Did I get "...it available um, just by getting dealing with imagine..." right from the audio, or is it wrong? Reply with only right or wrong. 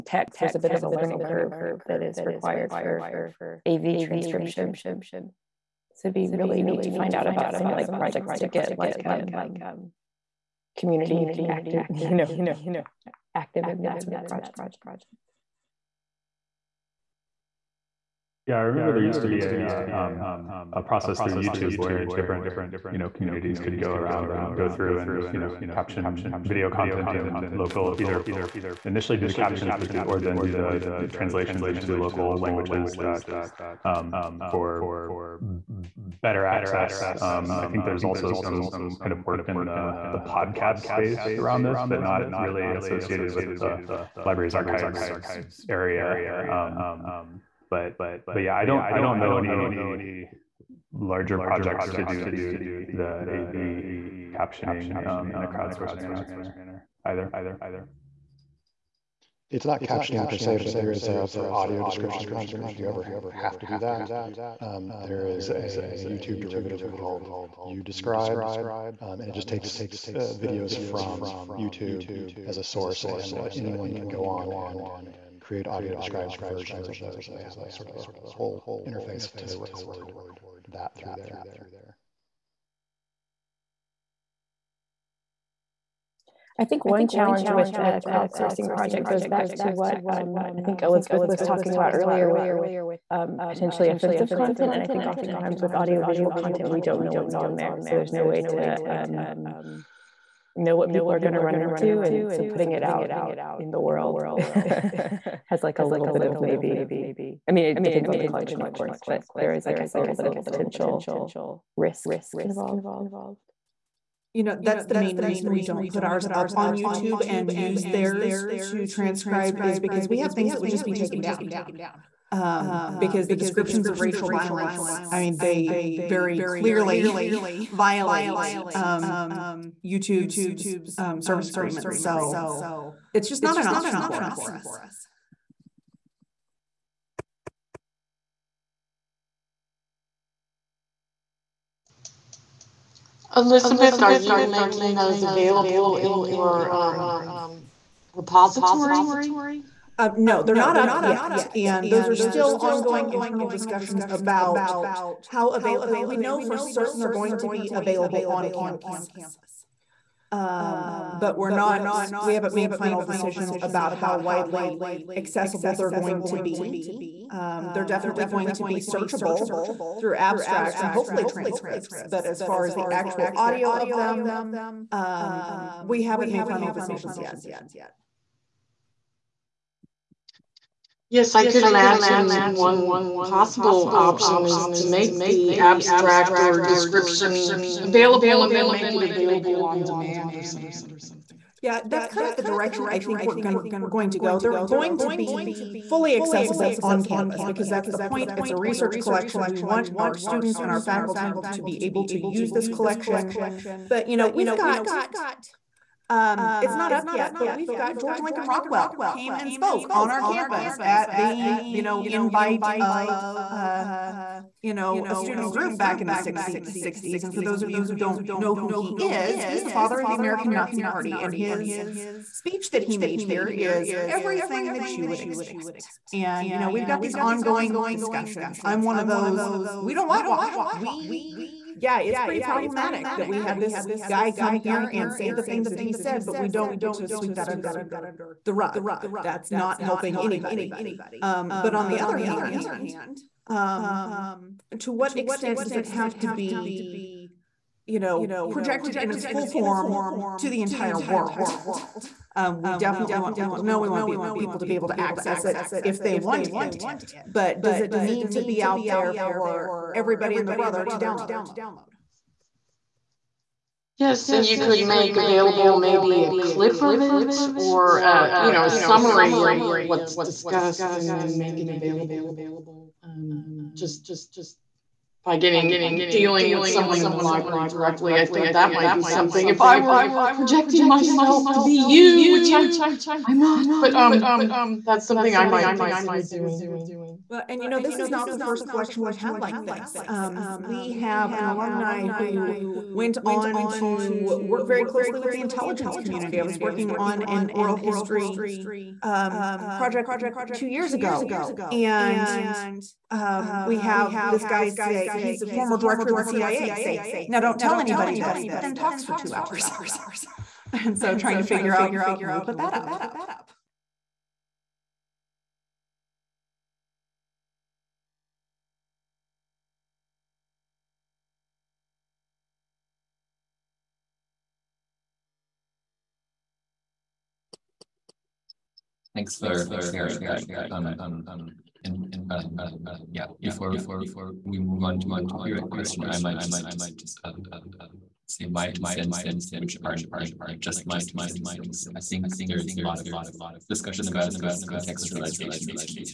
wrong.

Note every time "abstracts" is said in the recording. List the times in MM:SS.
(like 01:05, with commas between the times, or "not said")
02:50, 03:05.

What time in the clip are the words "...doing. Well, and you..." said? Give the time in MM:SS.
04:46.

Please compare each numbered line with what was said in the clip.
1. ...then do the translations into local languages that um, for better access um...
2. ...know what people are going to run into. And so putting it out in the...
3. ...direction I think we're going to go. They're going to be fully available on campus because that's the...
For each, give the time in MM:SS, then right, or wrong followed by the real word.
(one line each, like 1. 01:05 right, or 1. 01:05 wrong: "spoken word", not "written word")
1. 00:30 right
2. 01:40 right
3. 03:12 wrong: "accessible", not "available".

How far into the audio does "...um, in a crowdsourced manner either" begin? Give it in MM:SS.
00:55.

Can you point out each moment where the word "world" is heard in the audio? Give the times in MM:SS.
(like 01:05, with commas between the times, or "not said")
01:43, 04:11.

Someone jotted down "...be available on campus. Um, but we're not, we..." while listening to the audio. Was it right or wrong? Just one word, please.
right.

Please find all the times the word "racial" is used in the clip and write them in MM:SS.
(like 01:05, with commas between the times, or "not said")
02:03.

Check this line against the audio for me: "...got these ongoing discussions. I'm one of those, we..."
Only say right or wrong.
right.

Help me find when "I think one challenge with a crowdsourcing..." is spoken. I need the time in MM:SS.
01:26.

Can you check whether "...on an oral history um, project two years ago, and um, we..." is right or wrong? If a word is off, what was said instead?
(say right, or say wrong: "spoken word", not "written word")
right.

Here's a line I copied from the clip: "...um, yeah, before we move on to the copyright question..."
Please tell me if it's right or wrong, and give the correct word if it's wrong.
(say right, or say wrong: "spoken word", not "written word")
right.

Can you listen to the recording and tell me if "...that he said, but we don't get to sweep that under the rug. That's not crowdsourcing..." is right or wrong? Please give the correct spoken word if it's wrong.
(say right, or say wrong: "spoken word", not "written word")
wrong: "helping", not "crowdsourcing".